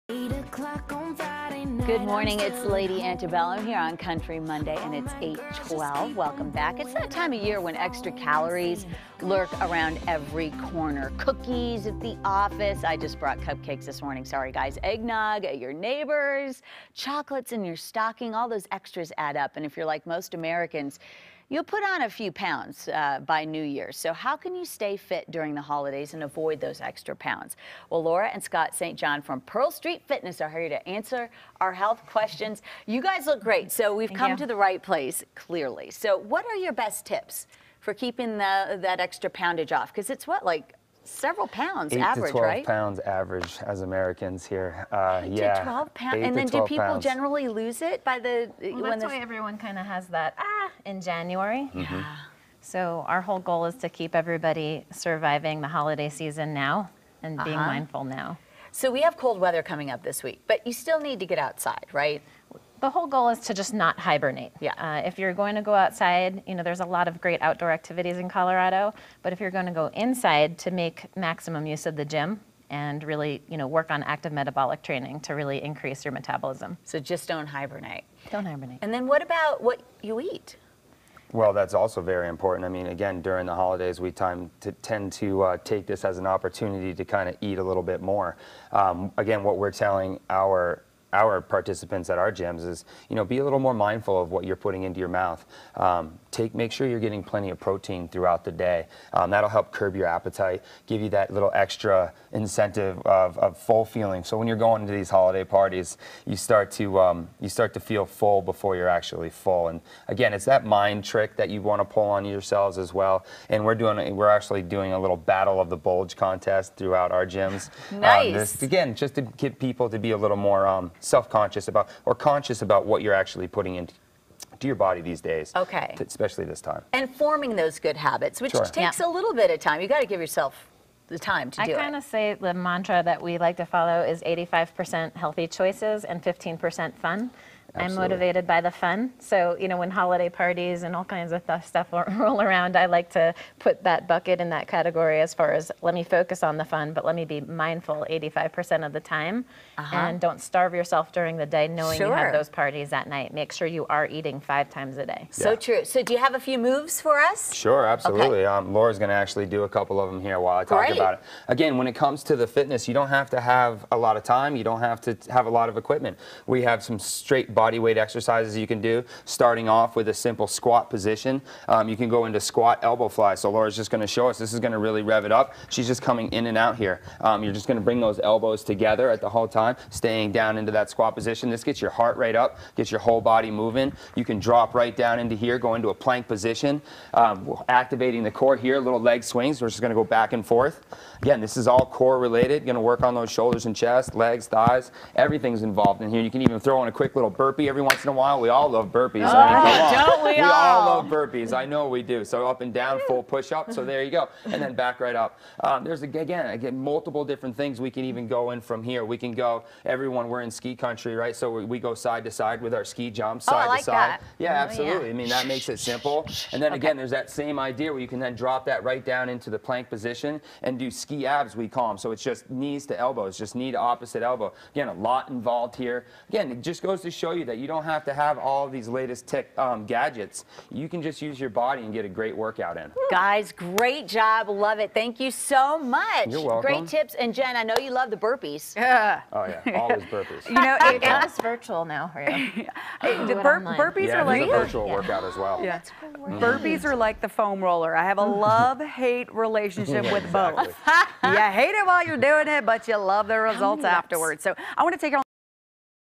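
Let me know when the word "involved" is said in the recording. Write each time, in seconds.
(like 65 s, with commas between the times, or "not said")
195 s, 225 s.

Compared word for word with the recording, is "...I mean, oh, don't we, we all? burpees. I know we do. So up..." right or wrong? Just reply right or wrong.
right.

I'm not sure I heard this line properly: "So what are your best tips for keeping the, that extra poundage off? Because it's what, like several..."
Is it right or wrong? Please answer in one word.
right.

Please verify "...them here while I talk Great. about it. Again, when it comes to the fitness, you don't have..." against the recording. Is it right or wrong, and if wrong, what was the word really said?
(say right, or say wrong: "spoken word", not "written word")
right.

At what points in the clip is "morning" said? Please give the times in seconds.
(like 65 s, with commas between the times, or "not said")
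2 s, 14 s.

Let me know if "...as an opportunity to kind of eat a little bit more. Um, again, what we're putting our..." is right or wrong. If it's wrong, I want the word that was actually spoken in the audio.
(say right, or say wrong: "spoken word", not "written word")
wrong: "telling", not "putting".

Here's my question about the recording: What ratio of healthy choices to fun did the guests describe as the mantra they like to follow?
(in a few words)
85% healthy, 15% fun.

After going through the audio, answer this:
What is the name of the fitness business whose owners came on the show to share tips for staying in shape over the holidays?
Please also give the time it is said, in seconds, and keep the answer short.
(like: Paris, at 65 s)
Pearl Street Fitness, at 29 s.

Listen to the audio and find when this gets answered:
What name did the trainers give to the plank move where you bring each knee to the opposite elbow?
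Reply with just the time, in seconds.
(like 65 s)
220 s.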